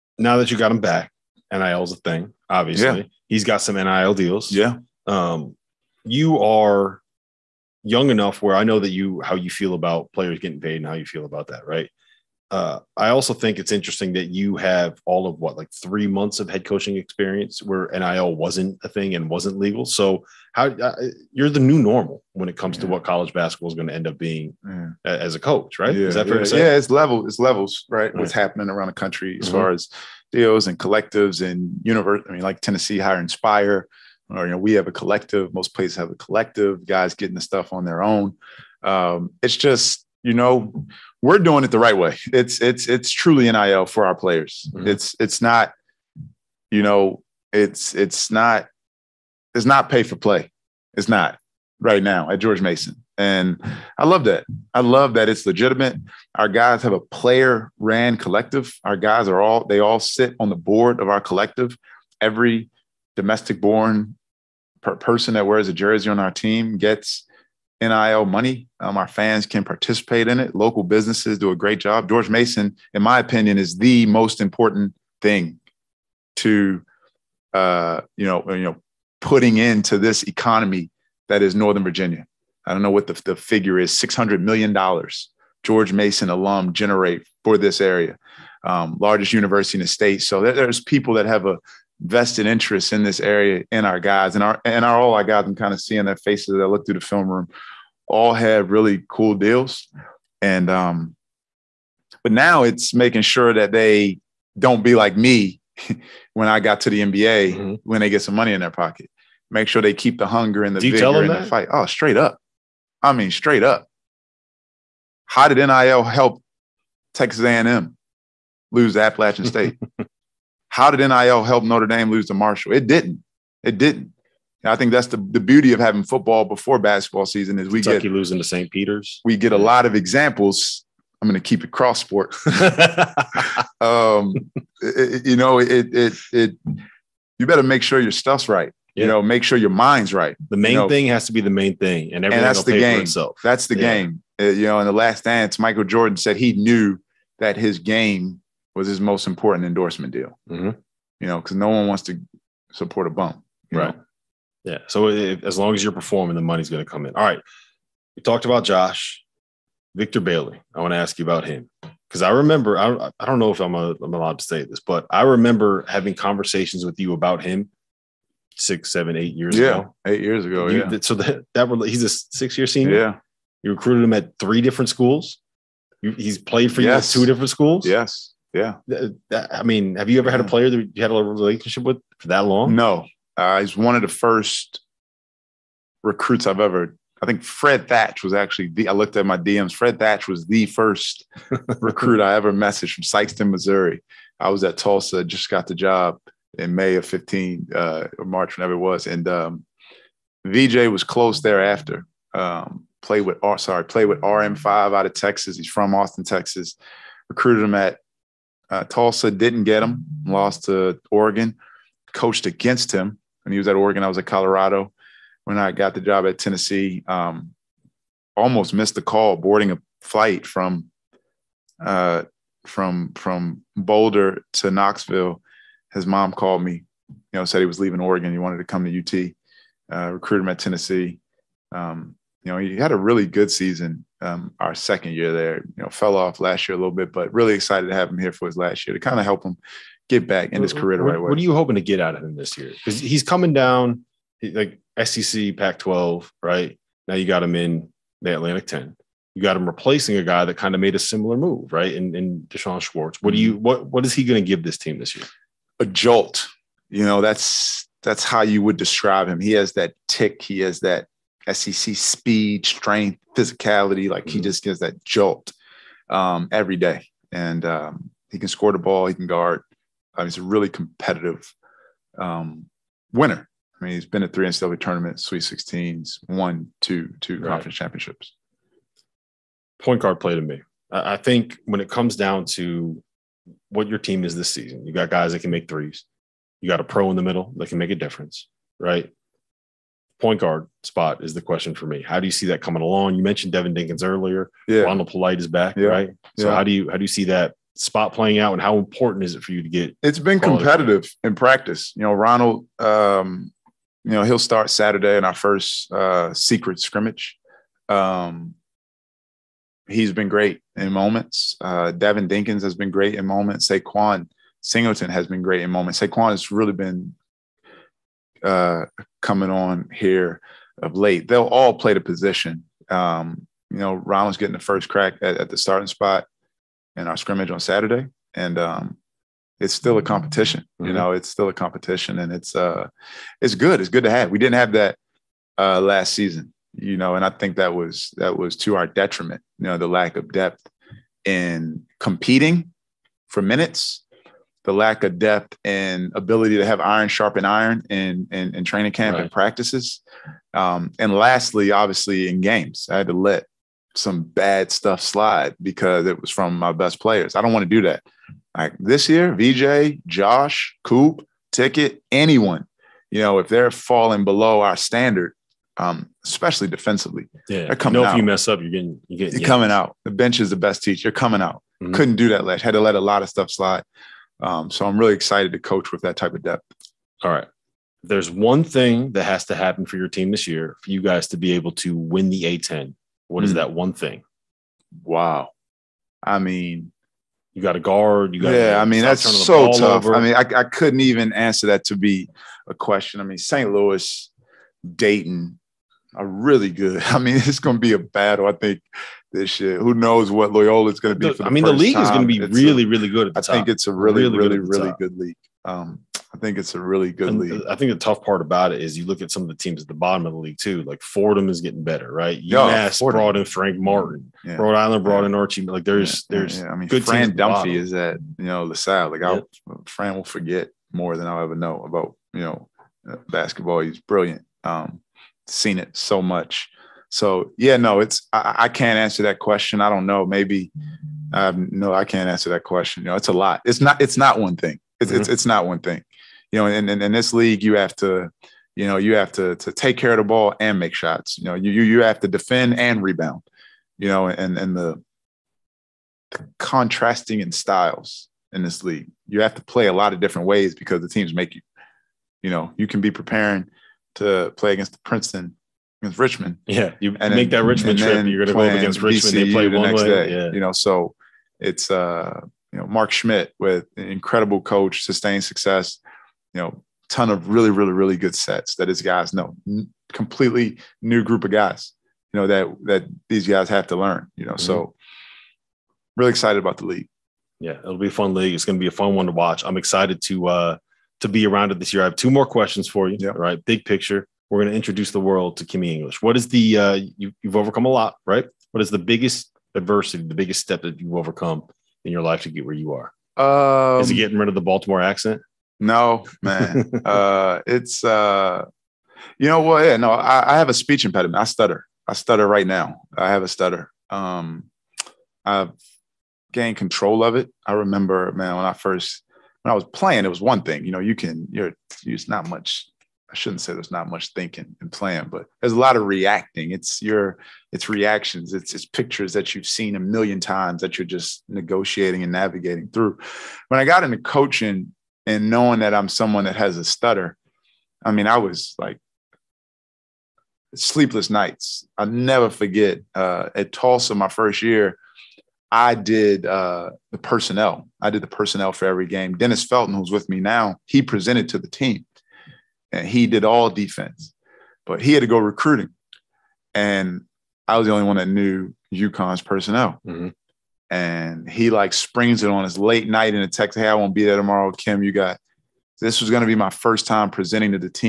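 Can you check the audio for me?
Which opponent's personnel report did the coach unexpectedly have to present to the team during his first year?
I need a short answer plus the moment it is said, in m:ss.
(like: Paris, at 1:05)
UConn, at 9:08.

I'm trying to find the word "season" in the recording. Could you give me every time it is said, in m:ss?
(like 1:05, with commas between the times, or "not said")
2:07, 3:53, 4:44, 5:36.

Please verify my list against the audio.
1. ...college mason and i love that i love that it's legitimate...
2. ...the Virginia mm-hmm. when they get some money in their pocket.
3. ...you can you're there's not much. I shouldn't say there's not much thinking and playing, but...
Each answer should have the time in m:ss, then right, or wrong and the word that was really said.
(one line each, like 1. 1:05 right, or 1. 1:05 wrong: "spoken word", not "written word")
1. 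0:52 wrong: "george", not "college"
2. 1:46 wrong: "NBA", not "Virginia"
3. 8:31 right.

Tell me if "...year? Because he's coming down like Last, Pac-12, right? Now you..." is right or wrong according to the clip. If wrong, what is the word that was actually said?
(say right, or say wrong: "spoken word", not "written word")
wrong: "SEC", not "Last".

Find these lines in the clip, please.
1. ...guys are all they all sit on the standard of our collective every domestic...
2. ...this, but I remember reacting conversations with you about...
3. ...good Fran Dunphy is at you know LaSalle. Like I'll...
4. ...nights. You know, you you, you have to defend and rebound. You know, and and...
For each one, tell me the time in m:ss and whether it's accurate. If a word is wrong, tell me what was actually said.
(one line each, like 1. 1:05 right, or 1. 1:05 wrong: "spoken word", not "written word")
1. 0:58 wrong: "board", not "standard"
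2. 2:44 wrong: "having", not "reacting"
3. 6:56 right
4. 7:20 wrong: "shots", not "nights".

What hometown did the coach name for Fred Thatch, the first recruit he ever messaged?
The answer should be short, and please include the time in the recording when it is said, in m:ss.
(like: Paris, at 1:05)
Sikeston, Missouri, at 3:13.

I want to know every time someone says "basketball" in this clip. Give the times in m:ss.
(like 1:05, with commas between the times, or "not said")
0:23, 2:06, 7:03.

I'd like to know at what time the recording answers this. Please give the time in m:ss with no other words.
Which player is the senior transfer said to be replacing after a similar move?
4:12.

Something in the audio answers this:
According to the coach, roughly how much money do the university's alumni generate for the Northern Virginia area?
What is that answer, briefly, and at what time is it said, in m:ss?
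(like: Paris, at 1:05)
$600 million, at 1:23.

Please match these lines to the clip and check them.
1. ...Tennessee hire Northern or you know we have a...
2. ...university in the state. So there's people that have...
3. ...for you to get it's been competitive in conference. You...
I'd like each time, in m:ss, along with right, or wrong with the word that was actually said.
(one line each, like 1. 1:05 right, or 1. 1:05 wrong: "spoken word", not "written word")
1. 0:32 wrong: "Inspire", not "Northern"
2. 1:29 right
3. 4:59 wrong: "practice", not "conference".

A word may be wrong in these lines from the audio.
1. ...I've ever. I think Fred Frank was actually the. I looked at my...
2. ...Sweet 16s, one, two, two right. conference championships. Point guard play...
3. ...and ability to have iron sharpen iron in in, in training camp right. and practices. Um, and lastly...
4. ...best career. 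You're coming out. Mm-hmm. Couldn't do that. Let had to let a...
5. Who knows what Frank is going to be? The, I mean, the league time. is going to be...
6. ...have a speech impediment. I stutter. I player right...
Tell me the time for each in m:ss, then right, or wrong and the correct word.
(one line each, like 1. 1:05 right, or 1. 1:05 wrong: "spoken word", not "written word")
1. 3:06 wrong: "Thatch", not "Frank"
2. 4:35 right
3. 5:45 right
4. 6:10 wrong: "teacher", not "career"
5. 6:39 wrong: "Loyola", not "Frank"
6. 8:20 wrong: "stutter", not "player".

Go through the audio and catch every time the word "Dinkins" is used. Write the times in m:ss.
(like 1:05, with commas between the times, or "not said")
4:53, 5:12.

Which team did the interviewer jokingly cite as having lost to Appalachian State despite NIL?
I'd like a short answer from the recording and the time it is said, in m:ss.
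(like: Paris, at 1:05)
Texas A&M, at 1:57.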